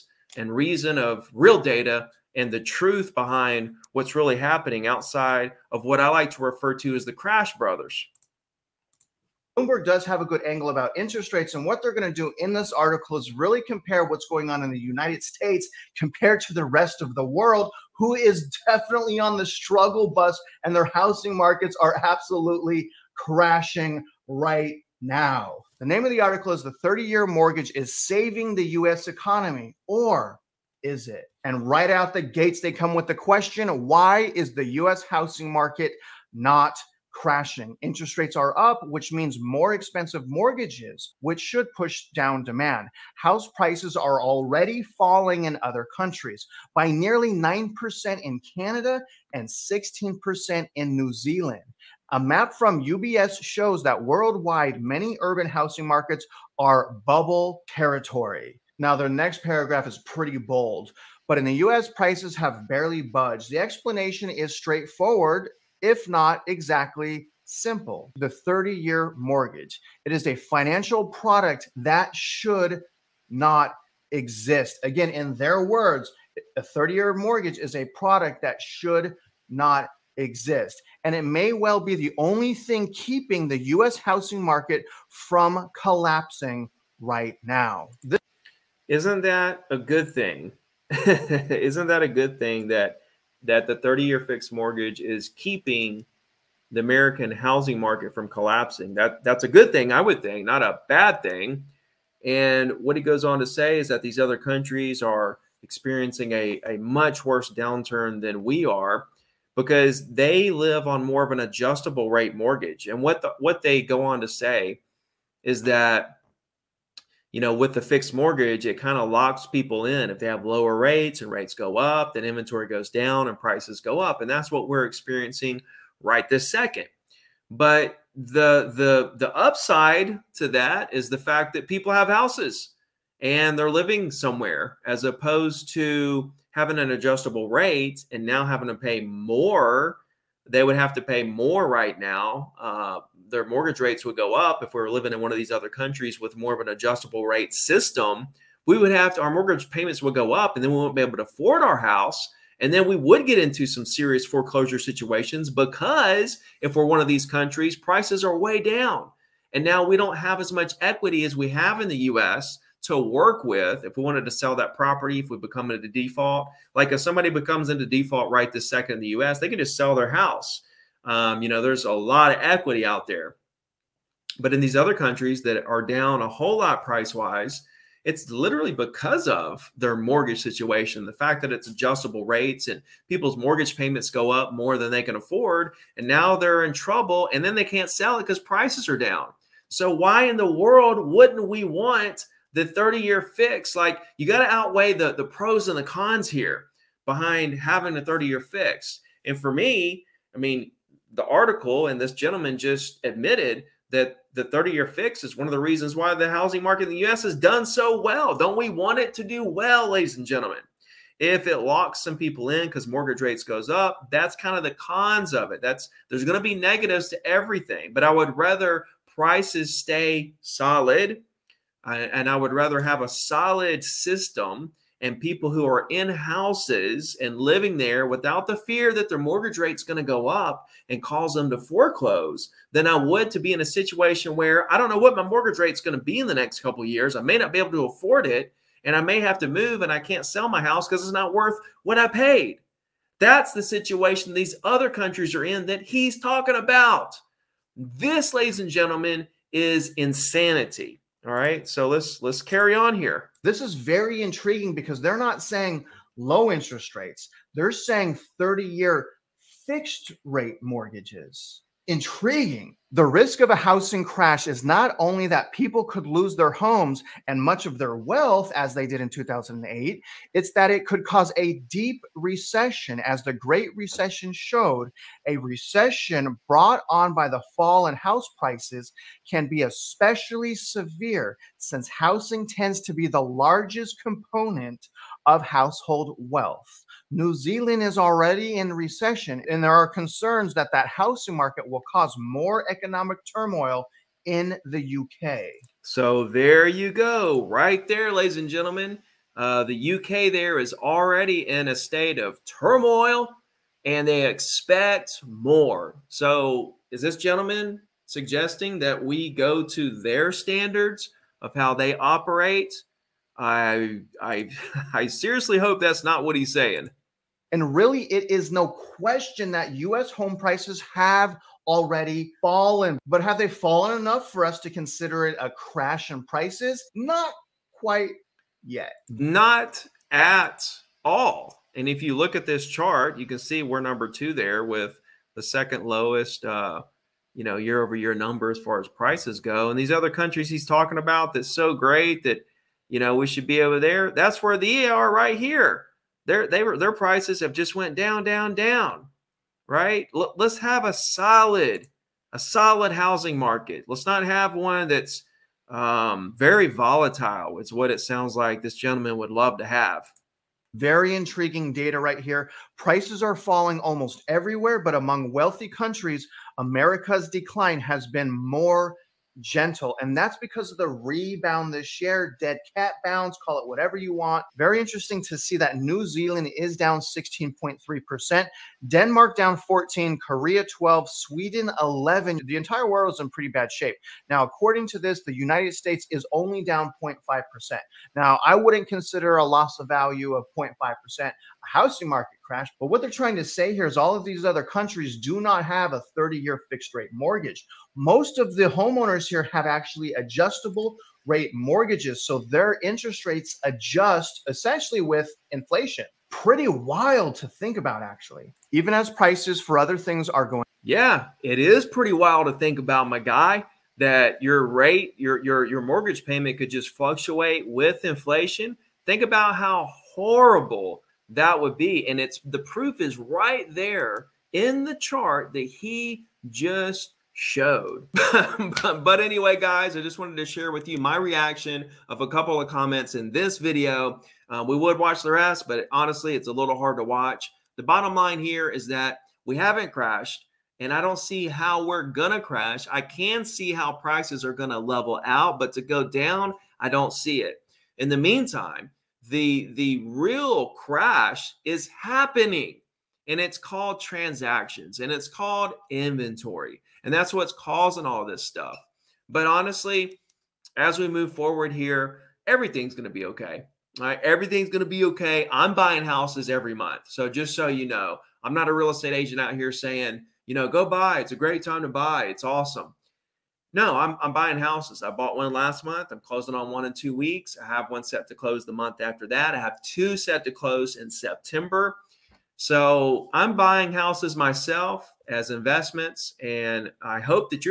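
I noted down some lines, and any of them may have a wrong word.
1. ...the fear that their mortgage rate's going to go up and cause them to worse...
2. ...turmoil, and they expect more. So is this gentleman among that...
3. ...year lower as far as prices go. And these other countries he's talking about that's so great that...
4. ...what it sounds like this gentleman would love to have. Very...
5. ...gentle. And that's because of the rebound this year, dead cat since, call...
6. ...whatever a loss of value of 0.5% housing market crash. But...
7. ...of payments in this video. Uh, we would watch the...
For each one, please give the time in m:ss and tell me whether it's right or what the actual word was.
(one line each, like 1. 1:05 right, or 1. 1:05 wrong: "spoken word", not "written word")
1. 3:48 wrong: "foreclose", not "worse"
2. 5:02 wrong: "suggesting", not "among"
3. 5:37 wrong: "number", not "lower"
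4. 5:57 right
5. 6:09 wrong: "bounce", not "since"
6. 6:28 wrong: "consider", not "whatever"
7. 7:12 wrong: "comments", not "payments".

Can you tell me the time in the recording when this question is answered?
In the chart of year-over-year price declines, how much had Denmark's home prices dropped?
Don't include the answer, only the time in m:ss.
6:18.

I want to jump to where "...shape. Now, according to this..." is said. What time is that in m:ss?
6:23.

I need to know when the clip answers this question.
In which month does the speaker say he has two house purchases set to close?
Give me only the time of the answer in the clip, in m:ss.
8:01.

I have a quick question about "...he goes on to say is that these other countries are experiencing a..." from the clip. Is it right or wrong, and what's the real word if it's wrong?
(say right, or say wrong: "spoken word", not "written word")
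right.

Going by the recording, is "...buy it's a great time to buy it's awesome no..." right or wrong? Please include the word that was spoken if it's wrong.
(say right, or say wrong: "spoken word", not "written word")
right.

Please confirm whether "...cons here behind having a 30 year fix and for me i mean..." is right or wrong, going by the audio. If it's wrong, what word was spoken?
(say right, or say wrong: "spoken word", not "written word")
right.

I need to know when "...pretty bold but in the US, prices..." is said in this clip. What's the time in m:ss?
0:59.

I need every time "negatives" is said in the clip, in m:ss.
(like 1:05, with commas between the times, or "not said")
3:36.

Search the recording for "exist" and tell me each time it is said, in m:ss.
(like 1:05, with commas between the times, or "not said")
1:14, 1:20.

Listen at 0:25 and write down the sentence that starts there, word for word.
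The name of the article is The 30 Year Mortgage is Saving the U.S.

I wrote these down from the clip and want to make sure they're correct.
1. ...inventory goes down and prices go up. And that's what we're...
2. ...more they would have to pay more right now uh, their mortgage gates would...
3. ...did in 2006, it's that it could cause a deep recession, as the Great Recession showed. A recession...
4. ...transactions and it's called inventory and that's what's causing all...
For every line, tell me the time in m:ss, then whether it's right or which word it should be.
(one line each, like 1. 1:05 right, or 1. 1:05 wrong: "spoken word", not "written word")
1. 2:02 right
2. 2:19 wrong: "rates", not "gates"
3. 4:28 wrong: "2008", not "2006"
4. 7:33 right.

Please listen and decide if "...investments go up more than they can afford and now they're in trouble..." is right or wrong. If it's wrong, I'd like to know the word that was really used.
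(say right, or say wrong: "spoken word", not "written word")
wrong: "payments", not "investments".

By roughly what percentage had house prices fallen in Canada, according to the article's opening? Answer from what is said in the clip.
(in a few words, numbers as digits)
9%.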